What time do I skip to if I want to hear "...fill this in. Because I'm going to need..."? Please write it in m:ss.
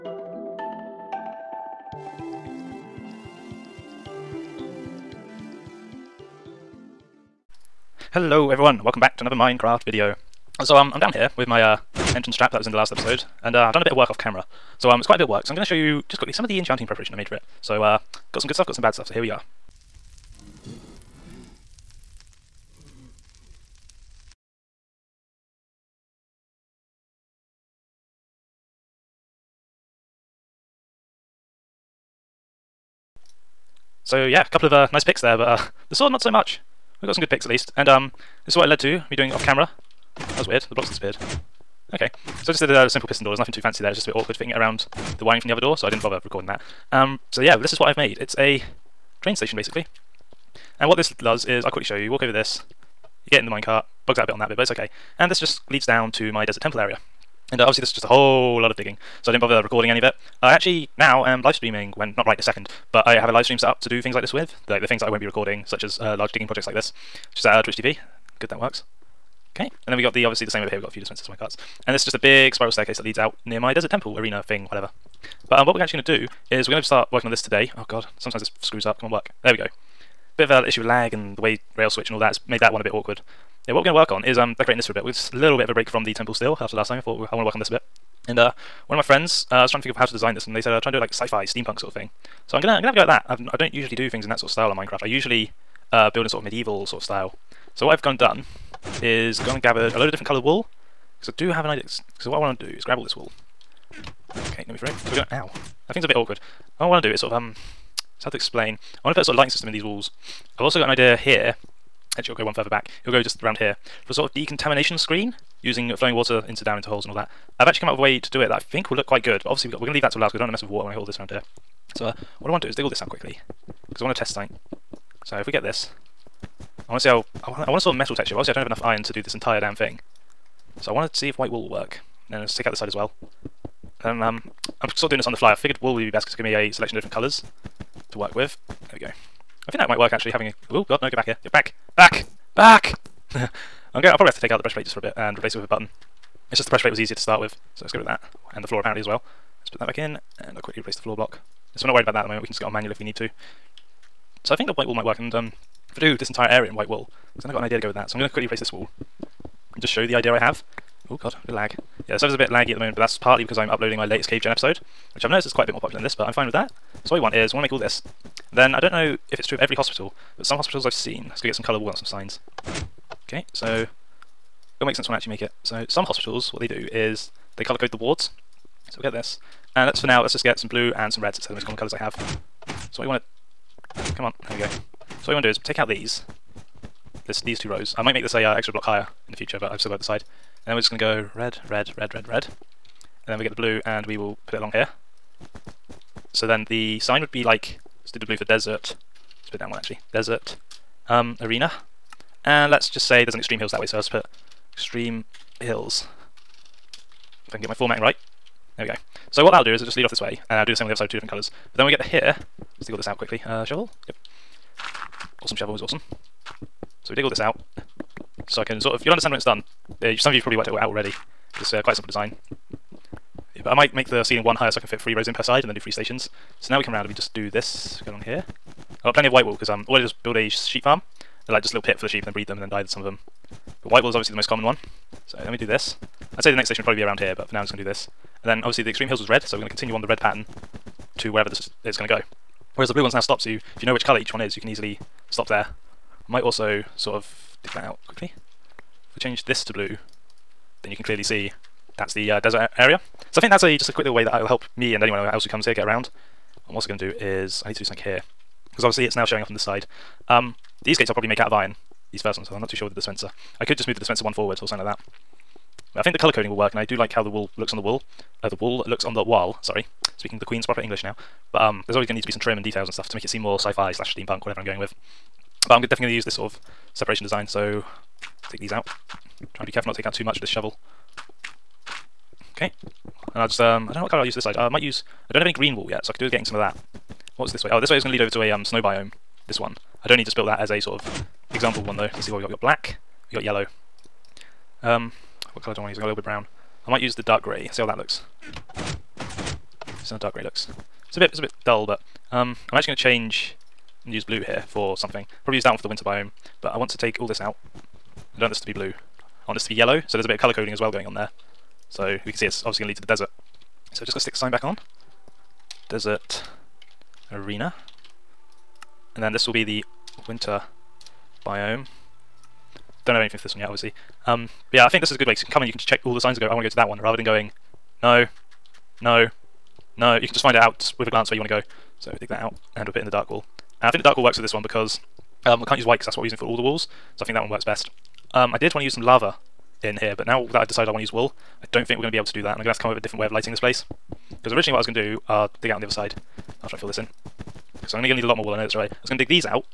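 5:46.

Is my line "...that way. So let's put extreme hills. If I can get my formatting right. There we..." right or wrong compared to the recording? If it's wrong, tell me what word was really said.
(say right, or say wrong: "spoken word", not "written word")
right.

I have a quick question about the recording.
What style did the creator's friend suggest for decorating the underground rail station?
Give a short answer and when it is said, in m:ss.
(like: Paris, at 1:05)
sci-fi, steampunk, at 1:31.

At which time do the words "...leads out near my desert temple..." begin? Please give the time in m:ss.
1:13.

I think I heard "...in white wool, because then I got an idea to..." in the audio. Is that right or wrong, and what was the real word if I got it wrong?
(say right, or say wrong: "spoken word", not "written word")
right.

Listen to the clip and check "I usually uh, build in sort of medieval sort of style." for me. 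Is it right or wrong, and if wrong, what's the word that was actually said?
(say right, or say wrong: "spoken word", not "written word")
right.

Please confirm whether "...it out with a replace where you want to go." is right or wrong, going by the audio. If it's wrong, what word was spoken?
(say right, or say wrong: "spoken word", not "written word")
wrong: "glance", not "replace".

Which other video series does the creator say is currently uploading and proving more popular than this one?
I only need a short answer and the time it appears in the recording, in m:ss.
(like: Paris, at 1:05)
Cave Gen, at 2:44.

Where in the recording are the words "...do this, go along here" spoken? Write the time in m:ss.
3:47.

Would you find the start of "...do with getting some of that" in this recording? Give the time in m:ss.
4:46.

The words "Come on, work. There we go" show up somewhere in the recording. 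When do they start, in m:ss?
1:18.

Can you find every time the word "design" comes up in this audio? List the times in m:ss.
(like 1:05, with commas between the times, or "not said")
1:30, 3:42, 4:37.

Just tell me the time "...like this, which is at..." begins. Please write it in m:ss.
1:06.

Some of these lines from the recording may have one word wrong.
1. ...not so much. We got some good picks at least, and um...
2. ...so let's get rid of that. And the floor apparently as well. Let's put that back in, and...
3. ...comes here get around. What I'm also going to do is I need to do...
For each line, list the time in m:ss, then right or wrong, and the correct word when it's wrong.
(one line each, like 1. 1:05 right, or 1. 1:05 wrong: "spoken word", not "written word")
1. 0:36 right
2. 2:27 right
3. 4:15 right.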